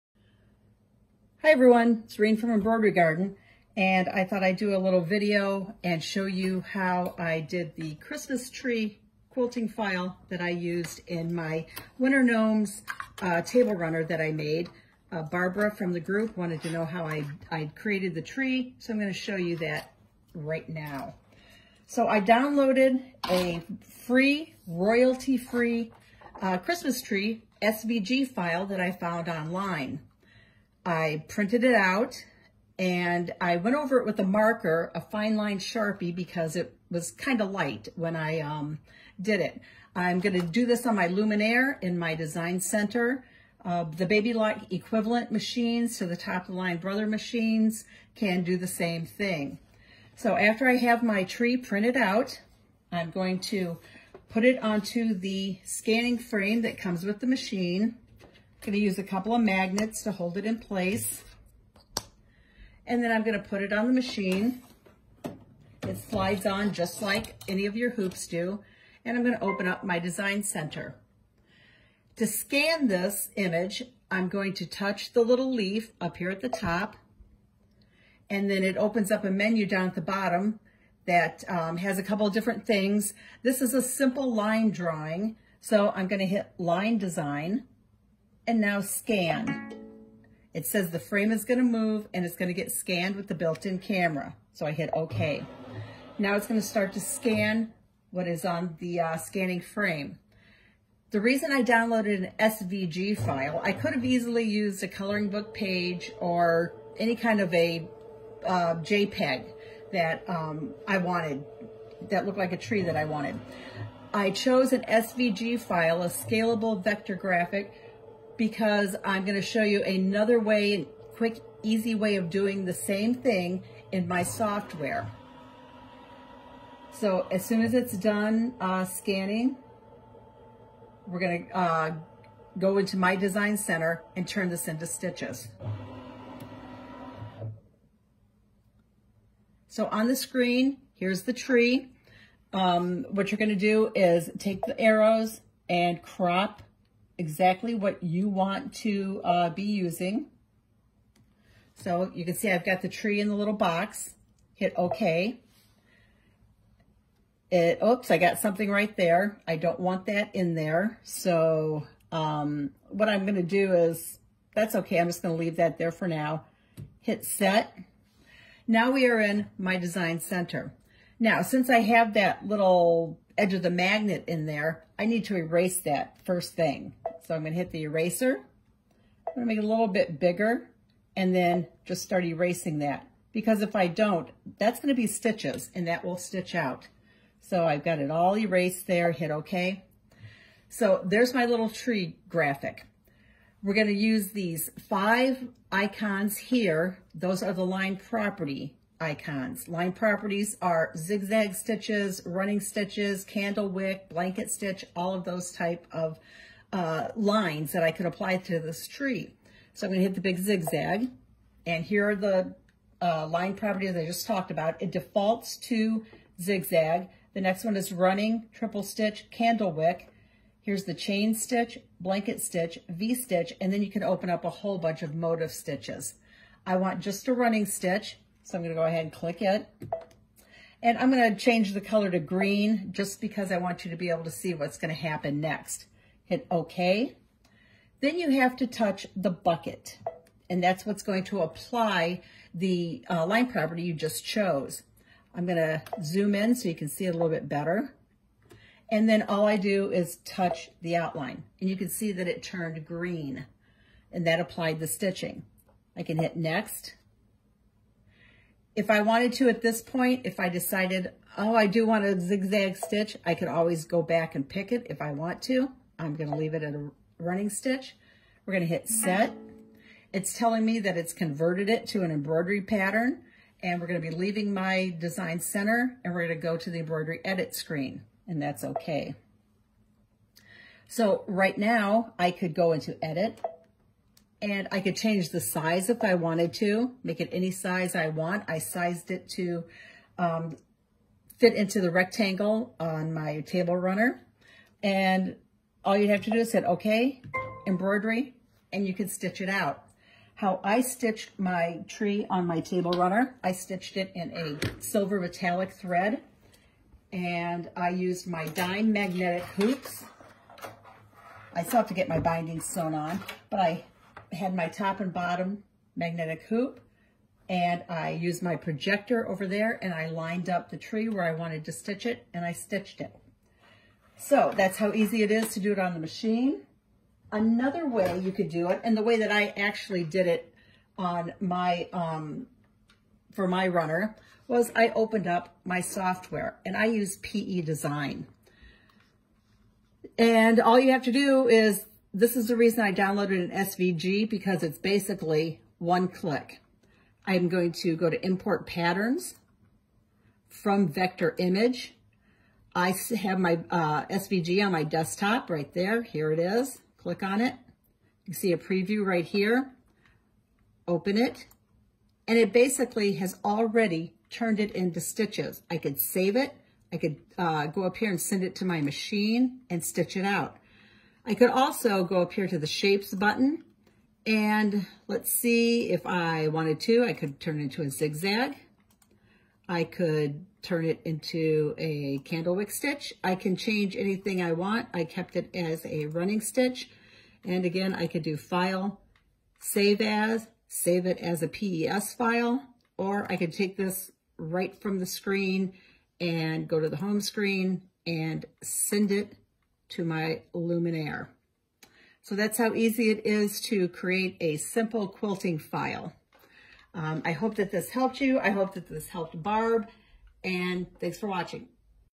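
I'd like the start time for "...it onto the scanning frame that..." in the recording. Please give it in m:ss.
0:54.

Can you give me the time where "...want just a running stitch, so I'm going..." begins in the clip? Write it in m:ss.
3:46.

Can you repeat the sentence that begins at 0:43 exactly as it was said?
Uh, the Baby Lock equivalent machines to the top of the line Brother machines can do the same thing.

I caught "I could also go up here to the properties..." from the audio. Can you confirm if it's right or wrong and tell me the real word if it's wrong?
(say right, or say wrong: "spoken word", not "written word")
wrong: "shapes", not "properties".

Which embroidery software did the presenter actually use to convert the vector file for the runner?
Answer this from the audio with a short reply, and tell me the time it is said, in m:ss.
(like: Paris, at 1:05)
PE Design, at 5:37.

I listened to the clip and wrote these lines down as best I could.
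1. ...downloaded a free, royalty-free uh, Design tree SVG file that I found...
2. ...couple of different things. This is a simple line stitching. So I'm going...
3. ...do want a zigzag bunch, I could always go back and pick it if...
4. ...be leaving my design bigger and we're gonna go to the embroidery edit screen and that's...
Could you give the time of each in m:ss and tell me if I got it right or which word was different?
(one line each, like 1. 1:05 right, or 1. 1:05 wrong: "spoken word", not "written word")
1. 0:22 wrong: "Christmas", not "Design"
2. 1:22 wrong: "drawing", not "stitching"
3. 4:21 wrong: "stitch", not "bunch"
4. 4:33 wrong: "center", not "bigger".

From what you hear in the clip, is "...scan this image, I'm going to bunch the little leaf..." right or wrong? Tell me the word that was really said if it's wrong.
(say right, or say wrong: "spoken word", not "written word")
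wrong: "touch", not "bunch".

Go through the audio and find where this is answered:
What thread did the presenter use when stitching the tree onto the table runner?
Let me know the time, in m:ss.
5:04.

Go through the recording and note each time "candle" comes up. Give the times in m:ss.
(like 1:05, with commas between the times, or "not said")
3:23, 3:39, 6:22.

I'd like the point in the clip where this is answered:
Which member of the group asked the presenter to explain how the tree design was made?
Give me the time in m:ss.
0:15.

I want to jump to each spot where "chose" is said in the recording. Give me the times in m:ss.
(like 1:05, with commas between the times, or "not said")
1:54, 4:04.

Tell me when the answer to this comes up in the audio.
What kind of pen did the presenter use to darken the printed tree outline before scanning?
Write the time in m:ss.
0:35.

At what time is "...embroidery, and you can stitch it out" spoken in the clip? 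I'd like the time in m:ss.
4:57.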